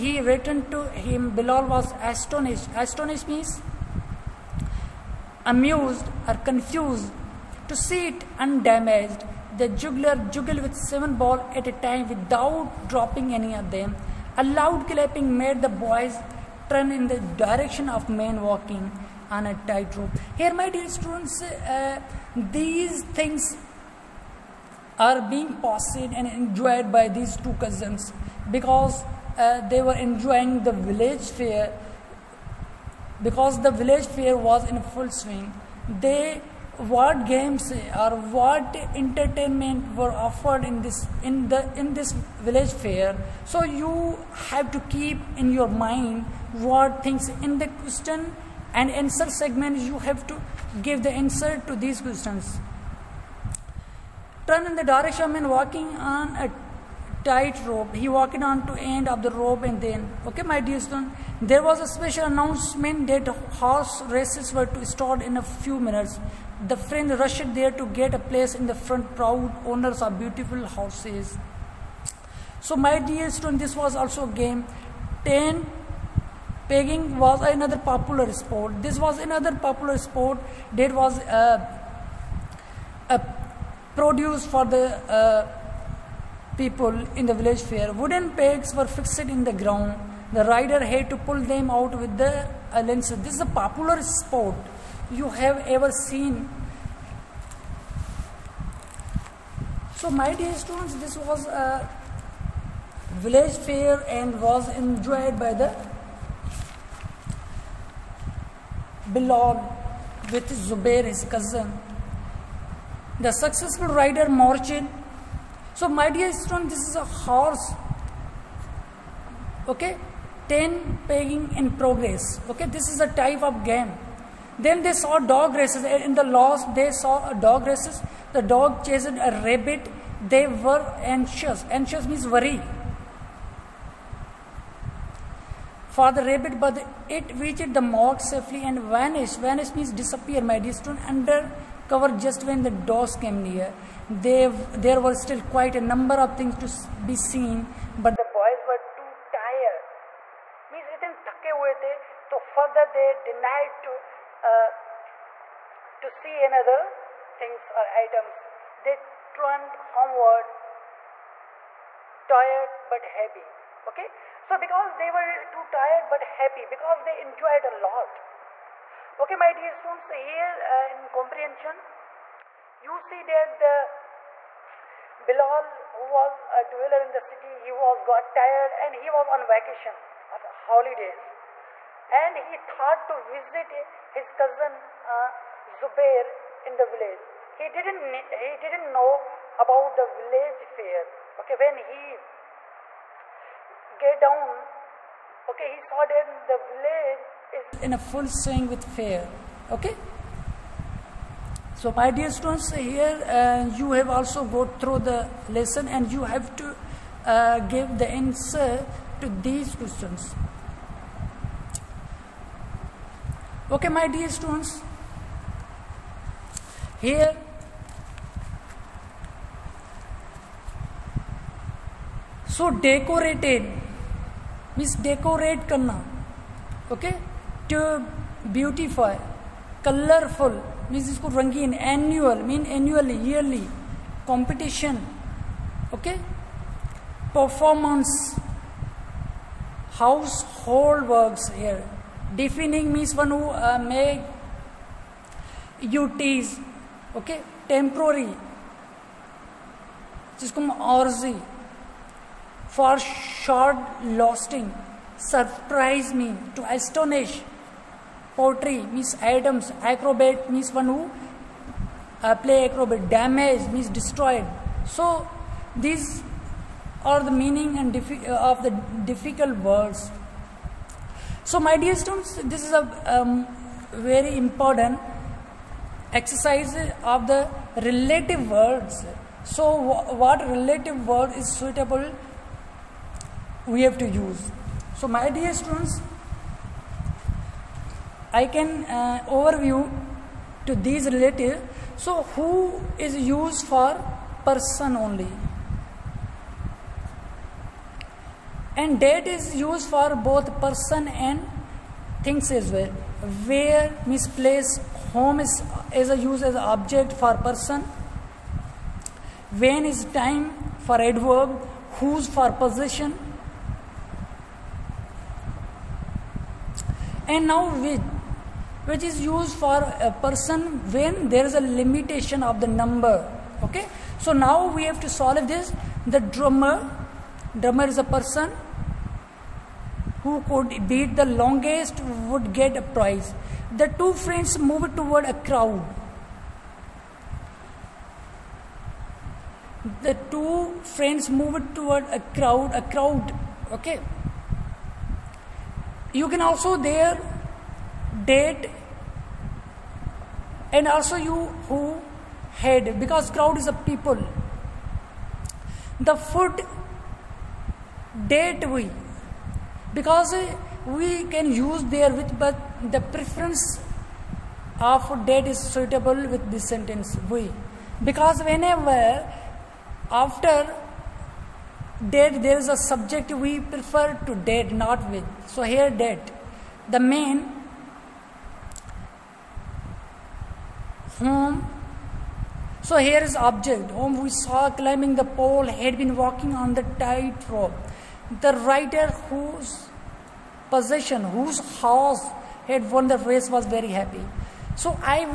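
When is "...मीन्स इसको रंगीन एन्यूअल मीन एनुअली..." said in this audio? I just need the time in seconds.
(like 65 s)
230 s.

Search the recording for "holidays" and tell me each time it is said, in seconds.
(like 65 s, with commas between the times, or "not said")
180 s.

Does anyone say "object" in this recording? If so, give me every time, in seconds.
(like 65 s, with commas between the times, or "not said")
306 s, 383 s.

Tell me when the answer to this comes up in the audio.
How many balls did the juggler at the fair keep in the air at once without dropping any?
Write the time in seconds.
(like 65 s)
10 s.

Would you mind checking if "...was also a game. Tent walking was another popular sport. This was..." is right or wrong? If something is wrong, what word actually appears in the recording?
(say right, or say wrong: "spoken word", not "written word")
wrong: "pegging", not "walking".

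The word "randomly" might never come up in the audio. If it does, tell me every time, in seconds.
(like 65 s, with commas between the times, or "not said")
not said.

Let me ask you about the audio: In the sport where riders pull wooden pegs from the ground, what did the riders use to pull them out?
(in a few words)
lances.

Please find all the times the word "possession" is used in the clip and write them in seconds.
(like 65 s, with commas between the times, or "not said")
312 s, 390 s.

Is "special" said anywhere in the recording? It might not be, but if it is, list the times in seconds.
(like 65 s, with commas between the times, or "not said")
61 s.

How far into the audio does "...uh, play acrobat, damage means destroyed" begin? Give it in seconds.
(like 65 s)
262 s.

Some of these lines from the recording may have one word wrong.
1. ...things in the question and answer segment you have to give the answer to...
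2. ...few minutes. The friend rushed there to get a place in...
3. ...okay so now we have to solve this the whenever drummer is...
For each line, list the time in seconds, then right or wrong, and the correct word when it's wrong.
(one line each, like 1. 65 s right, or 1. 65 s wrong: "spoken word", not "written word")
1. 47 s right
2. 65 s right
3. 323 s wrong: "drummer", not "whenever".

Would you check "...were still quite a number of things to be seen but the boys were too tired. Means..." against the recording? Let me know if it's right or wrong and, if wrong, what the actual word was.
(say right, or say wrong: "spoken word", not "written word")
right.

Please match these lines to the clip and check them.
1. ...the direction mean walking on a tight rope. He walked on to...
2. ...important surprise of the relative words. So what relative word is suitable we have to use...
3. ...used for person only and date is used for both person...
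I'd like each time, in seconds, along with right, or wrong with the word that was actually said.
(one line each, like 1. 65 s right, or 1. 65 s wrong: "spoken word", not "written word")
1. 54 s right
2. 274 s wrong: "exercise", not "surprise"
3. 293 s right.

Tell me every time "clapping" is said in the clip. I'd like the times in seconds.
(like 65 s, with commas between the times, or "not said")
14 s.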